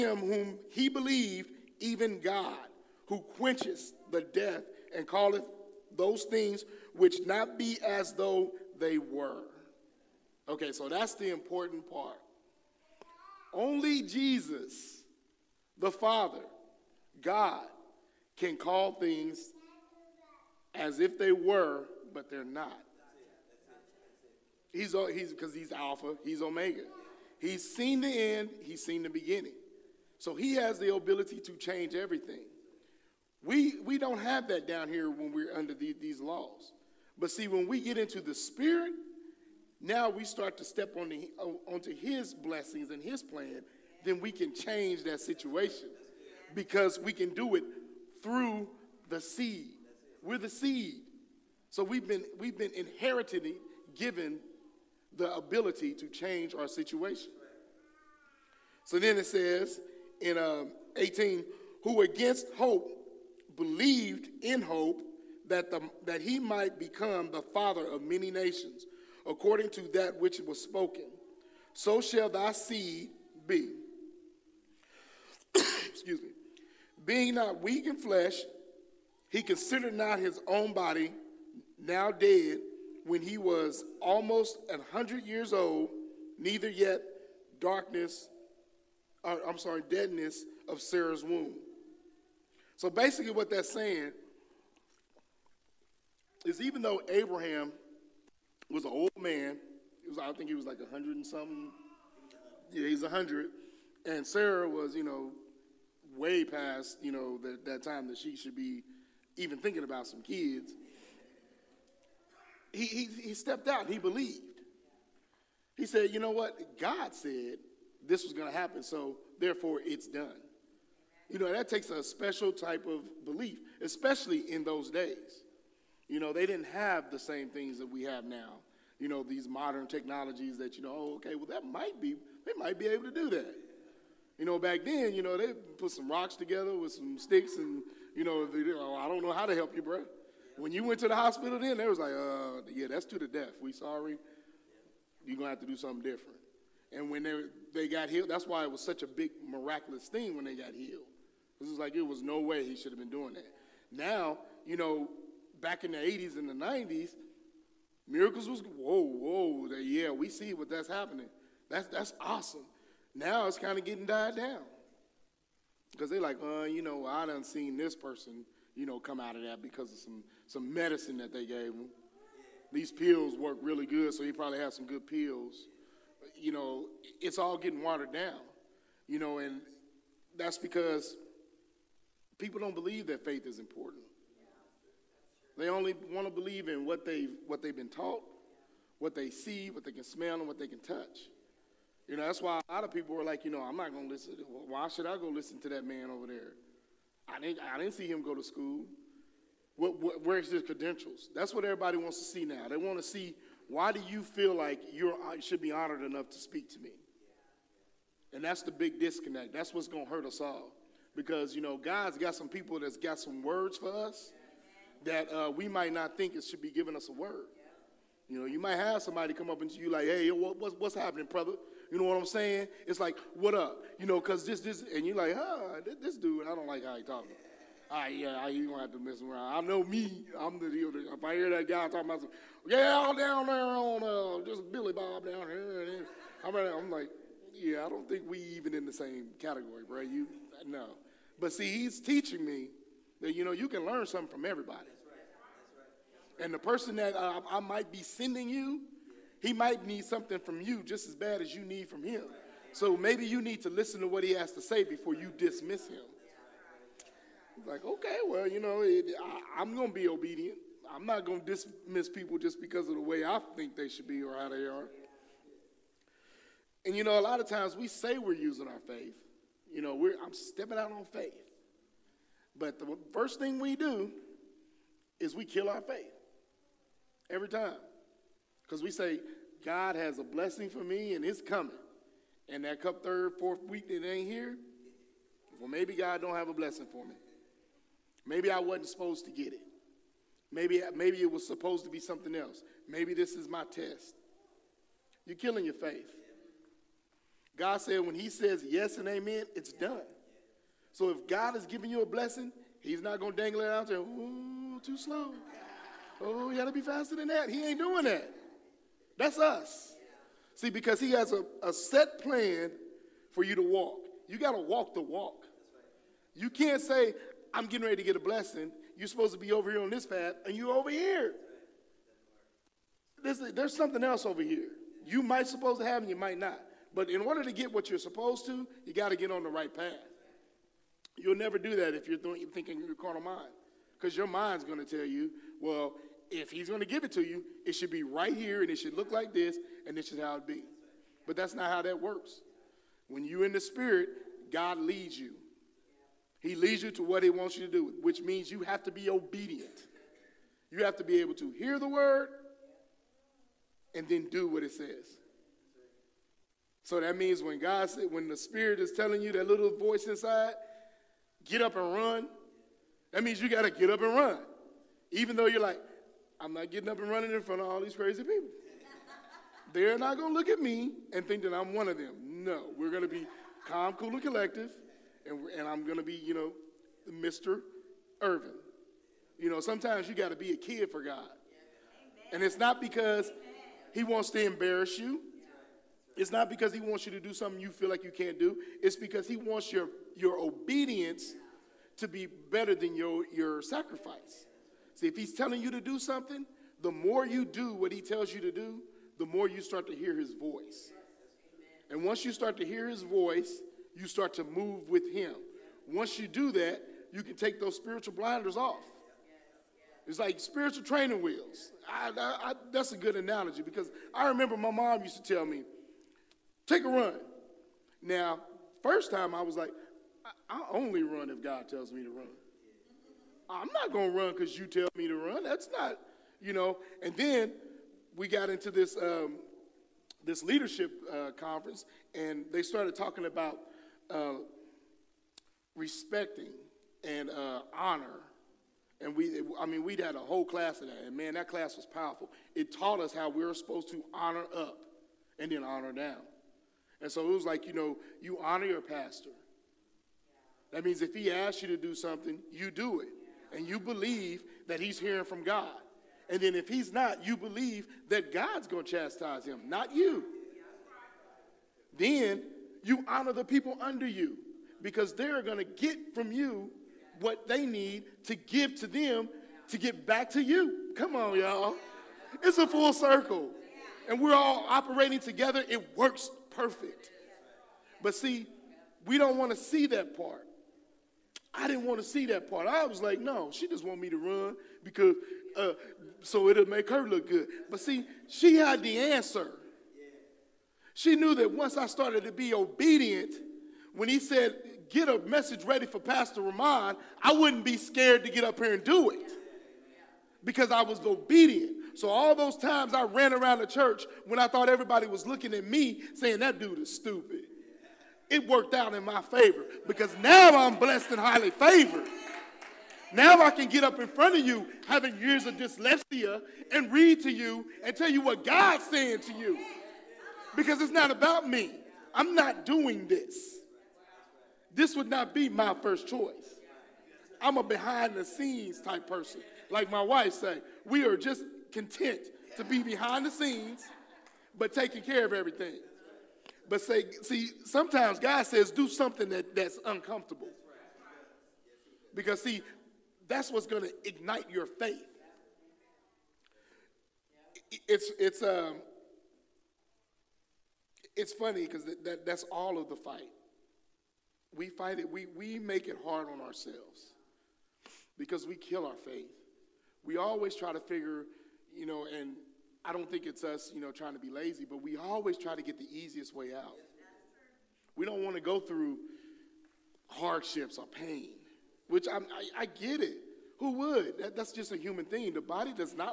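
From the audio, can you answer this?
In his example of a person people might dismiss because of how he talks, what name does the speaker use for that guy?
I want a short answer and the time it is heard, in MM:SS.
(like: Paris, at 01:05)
Billy Bob, at 03:54.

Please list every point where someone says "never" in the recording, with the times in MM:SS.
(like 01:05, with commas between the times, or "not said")
05:31.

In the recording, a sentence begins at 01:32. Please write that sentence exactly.
So basically, what that's saying is even though Abraham was an old man, was, I think he was like 100 and something.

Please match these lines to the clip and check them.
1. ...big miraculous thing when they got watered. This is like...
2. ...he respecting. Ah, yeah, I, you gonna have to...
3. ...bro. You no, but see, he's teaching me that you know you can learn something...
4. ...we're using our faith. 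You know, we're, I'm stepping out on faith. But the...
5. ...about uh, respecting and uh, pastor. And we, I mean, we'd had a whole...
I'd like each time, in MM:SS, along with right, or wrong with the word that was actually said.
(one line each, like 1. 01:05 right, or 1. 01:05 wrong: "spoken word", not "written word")
1. 02:29 wrong: "healed", not "watered"
2. 03:46 wrong: "talking", not "respecting"
3. 03:59 right
4. 04:28 right
5. 07:13 wrong: "honor", not "pastor".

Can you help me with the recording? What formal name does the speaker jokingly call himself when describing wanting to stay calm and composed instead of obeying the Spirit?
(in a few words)
Mr. Irvin.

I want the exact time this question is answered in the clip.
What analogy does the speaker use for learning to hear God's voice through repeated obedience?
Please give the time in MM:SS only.
06:50.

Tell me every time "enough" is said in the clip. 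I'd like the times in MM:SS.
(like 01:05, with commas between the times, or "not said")
03:26.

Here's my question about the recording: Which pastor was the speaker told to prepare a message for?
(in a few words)
Pastor Romon.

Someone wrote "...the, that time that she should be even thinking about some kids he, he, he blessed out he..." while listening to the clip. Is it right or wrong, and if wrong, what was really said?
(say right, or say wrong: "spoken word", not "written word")
wrong: "stepped", not "blessed".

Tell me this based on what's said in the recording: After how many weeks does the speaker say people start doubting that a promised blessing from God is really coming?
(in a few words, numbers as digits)
Third, fourth week.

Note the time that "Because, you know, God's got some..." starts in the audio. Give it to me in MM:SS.
03:31.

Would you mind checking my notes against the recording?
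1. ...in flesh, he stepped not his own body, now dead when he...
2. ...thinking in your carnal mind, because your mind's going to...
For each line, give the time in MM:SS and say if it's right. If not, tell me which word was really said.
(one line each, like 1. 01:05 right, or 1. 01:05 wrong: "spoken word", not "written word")
1. 01:17 wrong: "considered", not "stepped"
2. 05:32 right.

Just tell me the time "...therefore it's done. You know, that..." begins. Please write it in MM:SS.
01:59.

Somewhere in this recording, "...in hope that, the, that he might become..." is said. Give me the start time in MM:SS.
01:04.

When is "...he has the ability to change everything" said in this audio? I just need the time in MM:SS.
00:30.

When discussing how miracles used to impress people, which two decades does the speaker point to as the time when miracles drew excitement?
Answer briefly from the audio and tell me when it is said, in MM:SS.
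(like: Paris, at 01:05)
80s and 90s, at 02:35.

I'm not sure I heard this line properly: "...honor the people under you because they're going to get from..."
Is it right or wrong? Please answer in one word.
right.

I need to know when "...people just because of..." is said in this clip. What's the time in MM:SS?
04:22.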